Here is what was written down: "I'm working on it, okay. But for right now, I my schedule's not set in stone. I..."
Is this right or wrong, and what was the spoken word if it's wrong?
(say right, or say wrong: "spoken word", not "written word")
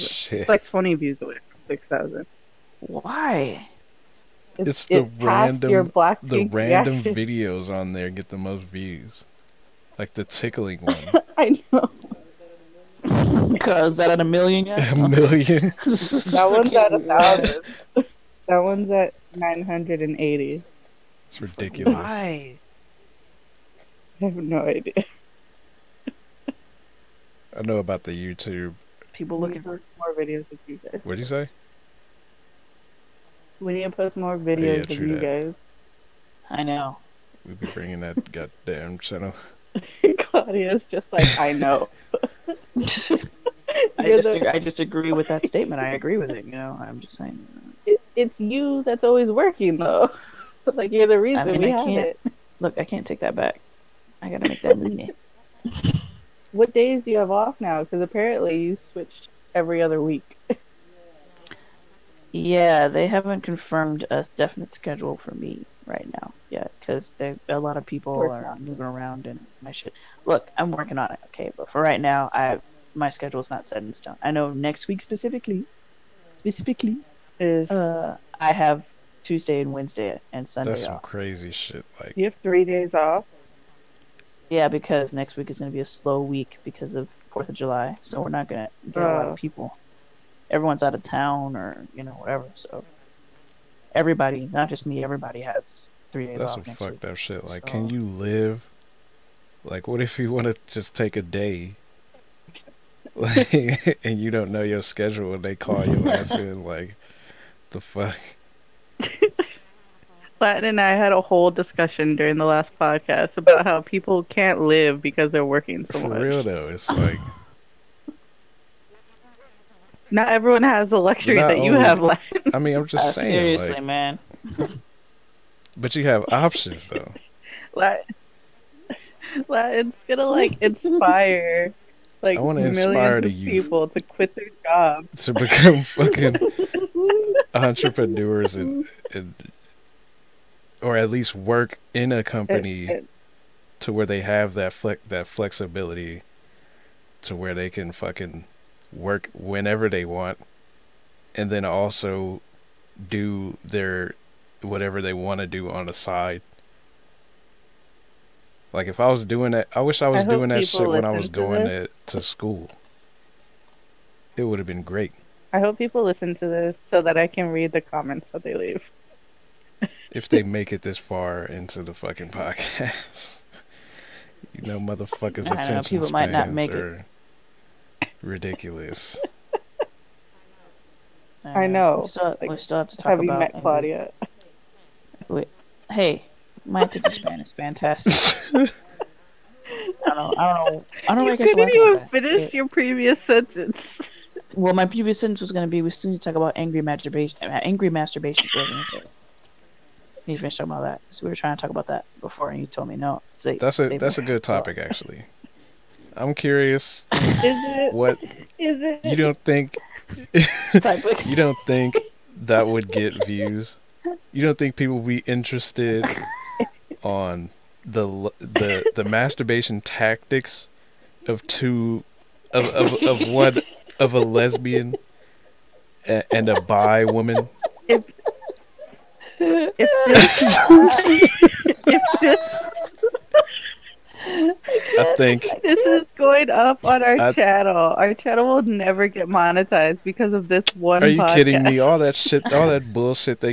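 right.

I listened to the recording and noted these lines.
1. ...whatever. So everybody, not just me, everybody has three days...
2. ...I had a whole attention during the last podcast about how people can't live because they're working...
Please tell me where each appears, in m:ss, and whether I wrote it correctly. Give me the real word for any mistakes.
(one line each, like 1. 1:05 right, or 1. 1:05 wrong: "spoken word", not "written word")
1. 1:32 right
2. 1:50 wrong: "discussion", not "attention".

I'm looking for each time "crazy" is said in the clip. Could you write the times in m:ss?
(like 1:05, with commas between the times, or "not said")
1:21.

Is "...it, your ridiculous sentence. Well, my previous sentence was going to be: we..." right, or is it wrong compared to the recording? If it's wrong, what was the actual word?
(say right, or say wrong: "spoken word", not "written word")
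wrong: "previous", not "ridiculous".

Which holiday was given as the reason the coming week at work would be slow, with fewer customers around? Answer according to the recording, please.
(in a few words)
Fourth of July.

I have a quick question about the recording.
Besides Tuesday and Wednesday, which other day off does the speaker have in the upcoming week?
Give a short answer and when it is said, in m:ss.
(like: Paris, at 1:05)
Sunday, at 1:20.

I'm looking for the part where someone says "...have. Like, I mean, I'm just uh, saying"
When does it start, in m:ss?
2:01.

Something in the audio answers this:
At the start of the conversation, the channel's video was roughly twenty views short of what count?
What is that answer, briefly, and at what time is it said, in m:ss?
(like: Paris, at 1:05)
6000, at 0:01.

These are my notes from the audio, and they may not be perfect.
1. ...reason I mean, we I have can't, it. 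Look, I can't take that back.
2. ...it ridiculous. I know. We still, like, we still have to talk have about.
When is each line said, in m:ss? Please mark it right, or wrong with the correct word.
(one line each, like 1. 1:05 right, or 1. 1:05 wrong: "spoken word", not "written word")
1. 0:51 right
2. 2:56 right.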